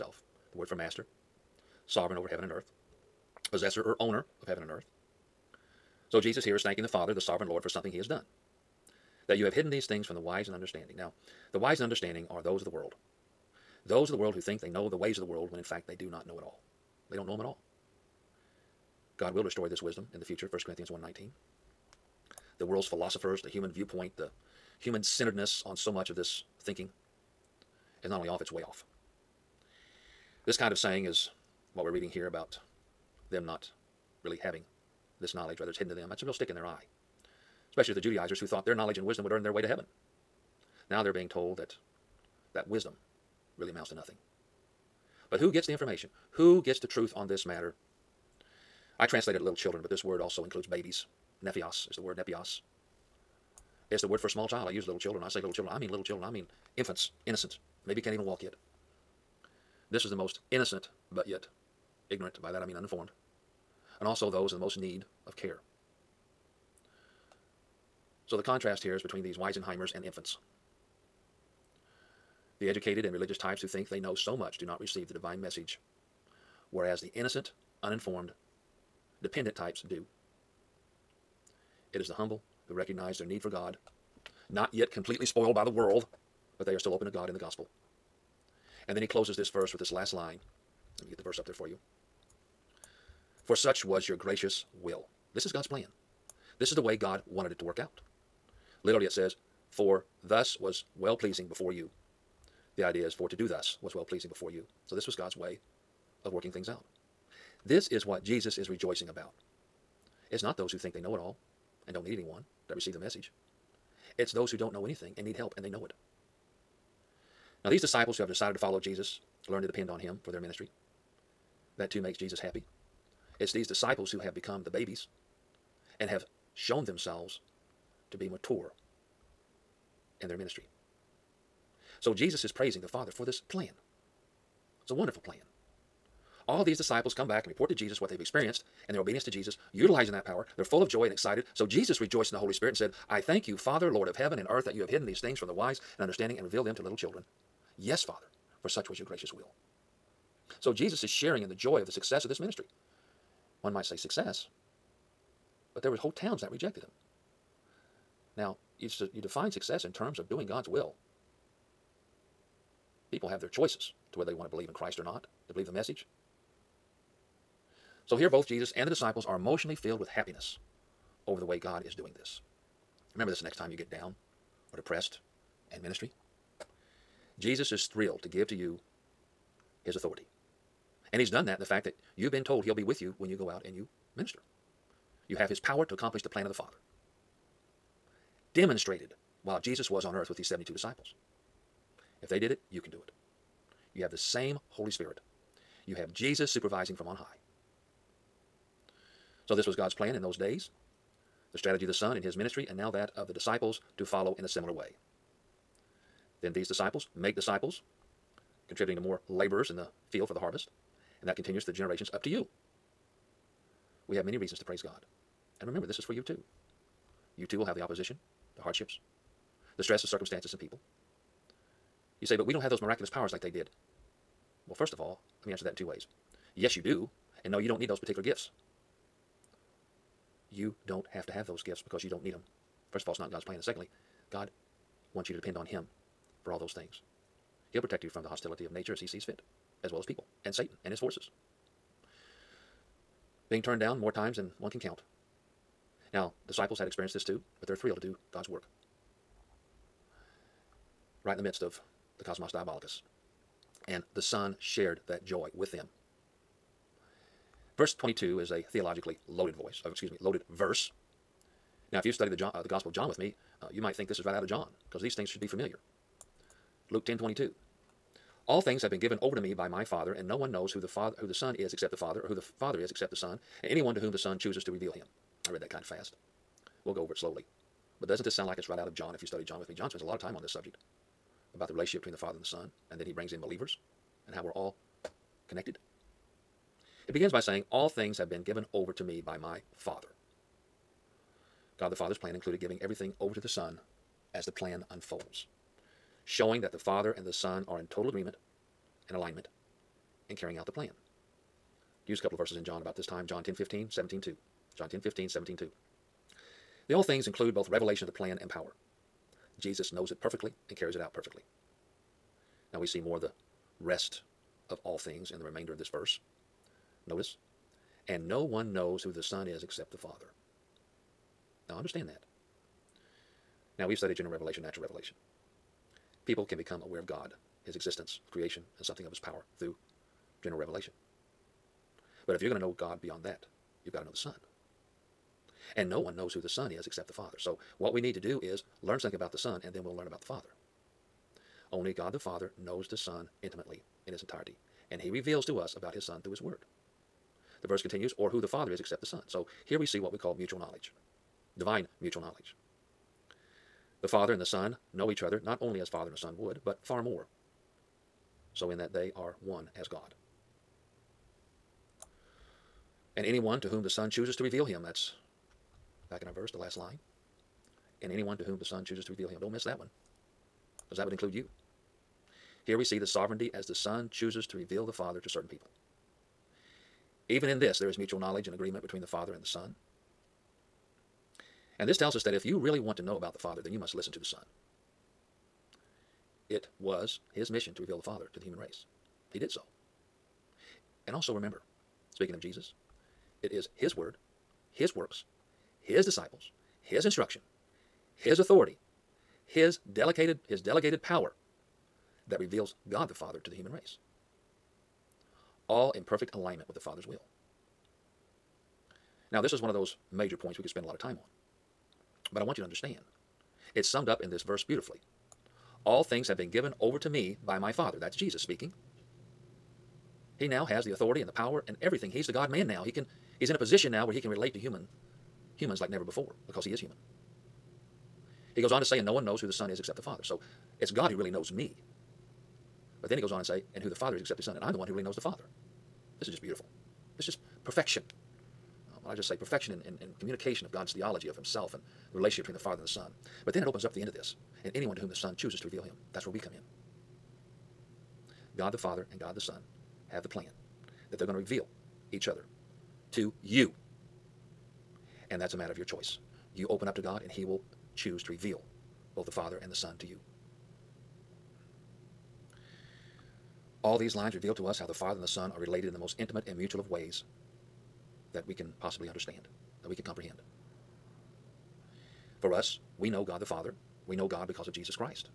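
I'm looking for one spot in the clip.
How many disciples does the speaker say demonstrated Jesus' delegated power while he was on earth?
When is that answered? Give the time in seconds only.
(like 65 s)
190 s.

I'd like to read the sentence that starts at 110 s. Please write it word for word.
It's not those who think they know it all and don't need anyone that receive the message.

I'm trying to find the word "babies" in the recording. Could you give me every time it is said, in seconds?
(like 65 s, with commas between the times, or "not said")
50 s, 124 s.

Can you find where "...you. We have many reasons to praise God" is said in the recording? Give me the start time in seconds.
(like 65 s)
212 s.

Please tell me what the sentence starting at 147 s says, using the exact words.
Yes, Father, for such was your gracious will.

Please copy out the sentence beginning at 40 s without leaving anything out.
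Now they're being told that that wisdom really amounts to nothing.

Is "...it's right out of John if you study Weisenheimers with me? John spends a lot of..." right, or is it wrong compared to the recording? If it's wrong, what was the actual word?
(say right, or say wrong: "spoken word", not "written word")
wrong: "John", not "Weisenheimers".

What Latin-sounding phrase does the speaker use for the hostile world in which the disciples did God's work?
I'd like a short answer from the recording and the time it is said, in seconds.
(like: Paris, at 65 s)
cosmos diabolicus, at 252 s.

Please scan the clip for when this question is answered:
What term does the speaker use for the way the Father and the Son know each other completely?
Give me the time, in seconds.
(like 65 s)
351 s.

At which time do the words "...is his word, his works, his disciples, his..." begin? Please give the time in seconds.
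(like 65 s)
393 s.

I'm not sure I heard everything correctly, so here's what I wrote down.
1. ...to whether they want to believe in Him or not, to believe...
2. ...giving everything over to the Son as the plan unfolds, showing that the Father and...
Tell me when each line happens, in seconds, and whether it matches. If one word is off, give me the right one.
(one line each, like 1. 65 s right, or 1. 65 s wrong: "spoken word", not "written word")
1. 164 s wrong: "Christ", not "Him"
2. 292 s right.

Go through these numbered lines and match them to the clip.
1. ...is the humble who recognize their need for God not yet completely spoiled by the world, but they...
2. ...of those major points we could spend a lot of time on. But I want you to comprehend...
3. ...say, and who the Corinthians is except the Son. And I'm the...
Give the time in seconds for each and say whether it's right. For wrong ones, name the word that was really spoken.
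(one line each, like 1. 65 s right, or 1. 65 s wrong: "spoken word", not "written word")
1. 81 s right
2. 409 s wrong: "understand", not "comprehend"
3. 433 s wrong: "Father", not "Corinthians".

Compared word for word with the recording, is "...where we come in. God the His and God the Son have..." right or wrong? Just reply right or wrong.
wrong.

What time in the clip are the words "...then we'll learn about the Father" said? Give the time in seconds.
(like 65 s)
339 s.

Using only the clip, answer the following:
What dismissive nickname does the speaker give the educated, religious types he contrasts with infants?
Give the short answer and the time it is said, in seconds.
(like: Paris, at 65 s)
Weisenheimers, at 69 s.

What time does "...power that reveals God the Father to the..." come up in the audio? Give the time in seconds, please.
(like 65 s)
401 s.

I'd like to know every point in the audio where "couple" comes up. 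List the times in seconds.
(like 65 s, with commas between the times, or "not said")
302 s.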